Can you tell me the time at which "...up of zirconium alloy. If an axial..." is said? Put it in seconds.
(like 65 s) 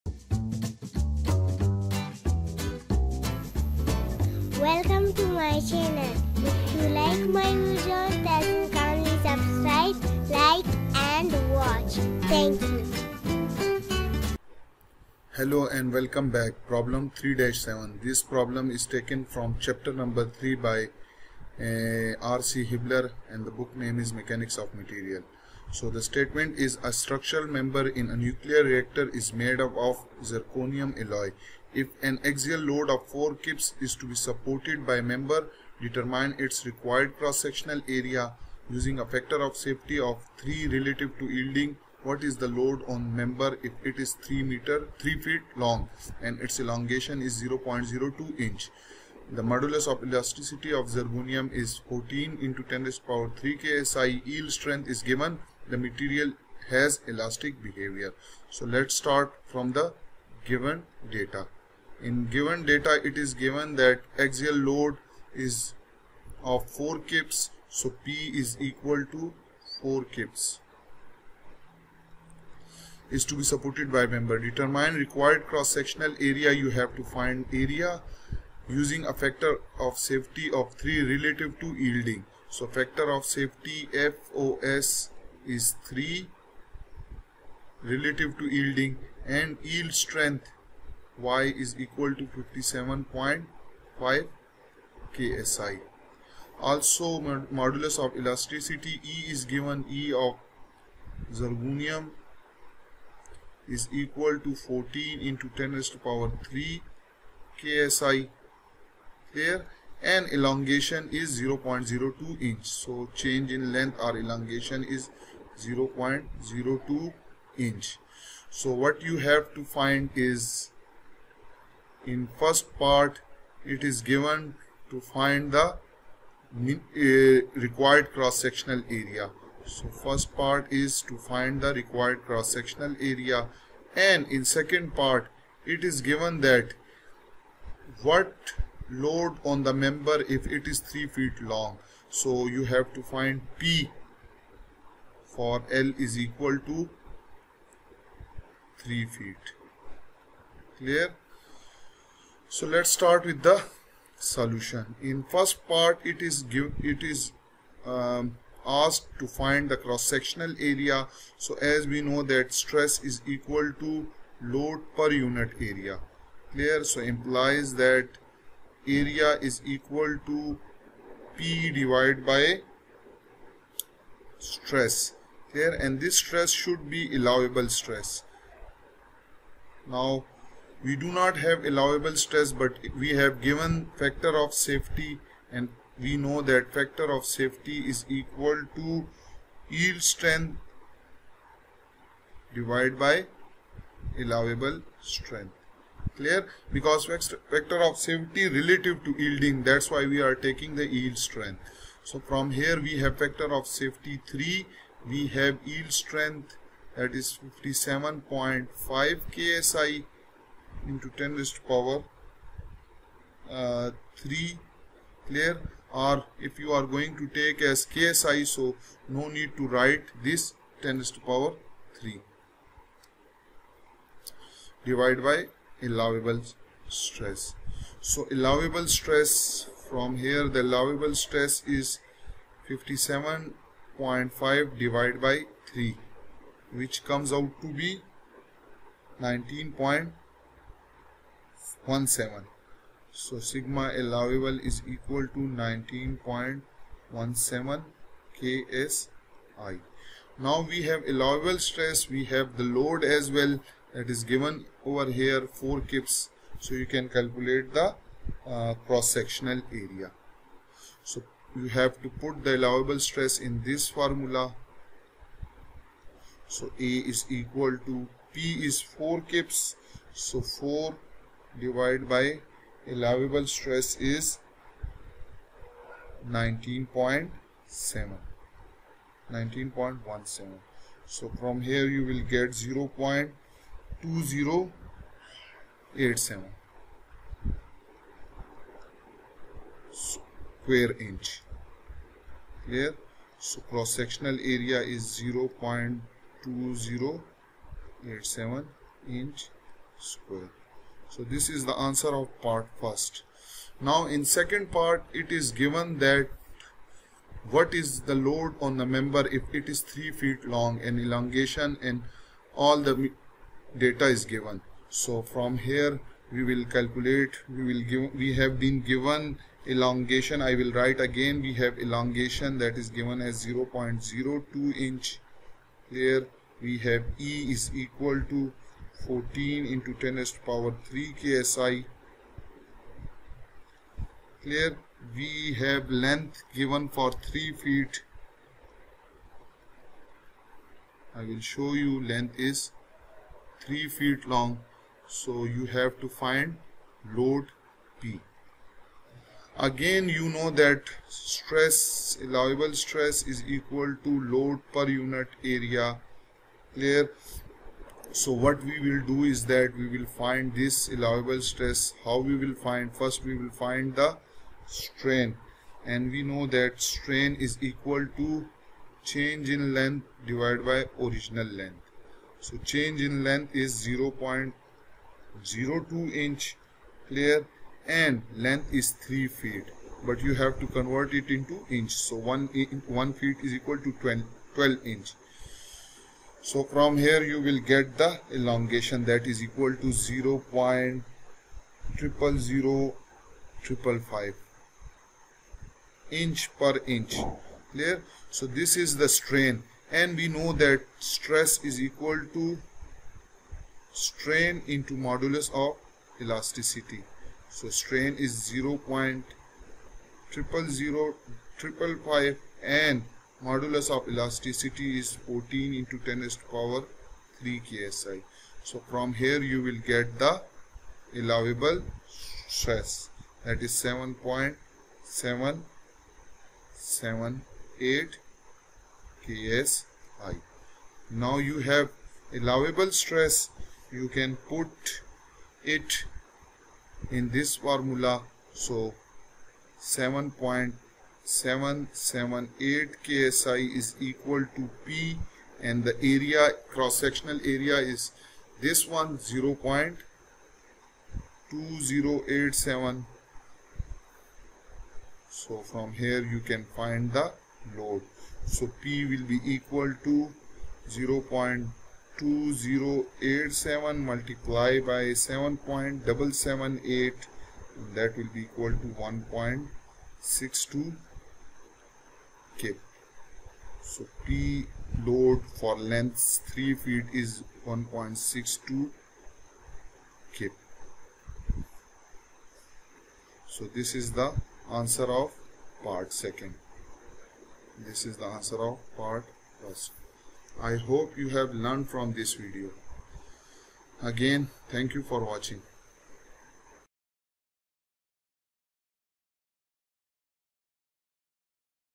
29 s.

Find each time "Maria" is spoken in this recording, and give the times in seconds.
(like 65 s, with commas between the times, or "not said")
not said.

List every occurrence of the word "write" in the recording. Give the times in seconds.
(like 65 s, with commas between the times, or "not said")
219 s, 320 s.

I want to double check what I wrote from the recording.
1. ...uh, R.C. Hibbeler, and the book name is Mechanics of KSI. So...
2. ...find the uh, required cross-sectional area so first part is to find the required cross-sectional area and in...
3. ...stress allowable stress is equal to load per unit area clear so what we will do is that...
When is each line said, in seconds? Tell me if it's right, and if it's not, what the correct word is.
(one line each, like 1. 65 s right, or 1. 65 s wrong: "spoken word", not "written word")
1. 21 s wrong: "Material", not "KSI"
2. 124 s right
3. 351 s right.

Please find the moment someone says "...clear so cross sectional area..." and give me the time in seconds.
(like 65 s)
292 s.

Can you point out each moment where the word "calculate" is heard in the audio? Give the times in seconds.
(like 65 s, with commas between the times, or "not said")
257 s, 316 s.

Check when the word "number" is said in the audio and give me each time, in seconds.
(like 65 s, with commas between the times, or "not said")
19 s.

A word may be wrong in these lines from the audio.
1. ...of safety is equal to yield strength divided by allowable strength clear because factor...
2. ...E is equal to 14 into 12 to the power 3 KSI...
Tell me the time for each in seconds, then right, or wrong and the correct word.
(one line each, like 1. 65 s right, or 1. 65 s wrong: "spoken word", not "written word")
1. 187 s right
2. 327 s wrong: "10", not "12".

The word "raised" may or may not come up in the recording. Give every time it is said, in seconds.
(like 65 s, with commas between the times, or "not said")
105 s, 211 s, 220 s.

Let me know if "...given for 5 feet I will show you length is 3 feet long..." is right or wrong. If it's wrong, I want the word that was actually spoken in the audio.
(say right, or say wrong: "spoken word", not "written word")
wrong: "3", not "5".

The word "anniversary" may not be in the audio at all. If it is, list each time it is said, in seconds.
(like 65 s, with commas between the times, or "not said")
not said.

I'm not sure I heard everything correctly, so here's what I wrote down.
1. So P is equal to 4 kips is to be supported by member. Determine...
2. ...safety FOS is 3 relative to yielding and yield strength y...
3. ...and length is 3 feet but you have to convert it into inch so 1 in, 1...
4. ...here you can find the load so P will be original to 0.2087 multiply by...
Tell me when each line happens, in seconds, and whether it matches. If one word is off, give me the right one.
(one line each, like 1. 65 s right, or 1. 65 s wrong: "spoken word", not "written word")
1. 67 s right
2. 83 s right
3. 377 s right
4. 455 s wrong: "equal", not "original".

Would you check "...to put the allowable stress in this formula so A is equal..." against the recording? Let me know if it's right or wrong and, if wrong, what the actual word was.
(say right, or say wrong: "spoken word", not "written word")
right.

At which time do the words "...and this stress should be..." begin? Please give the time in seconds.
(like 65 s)
175 s.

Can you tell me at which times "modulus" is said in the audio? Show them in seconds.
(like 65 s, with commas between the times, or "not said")
49 s, 97 s, 405 s, 413 s.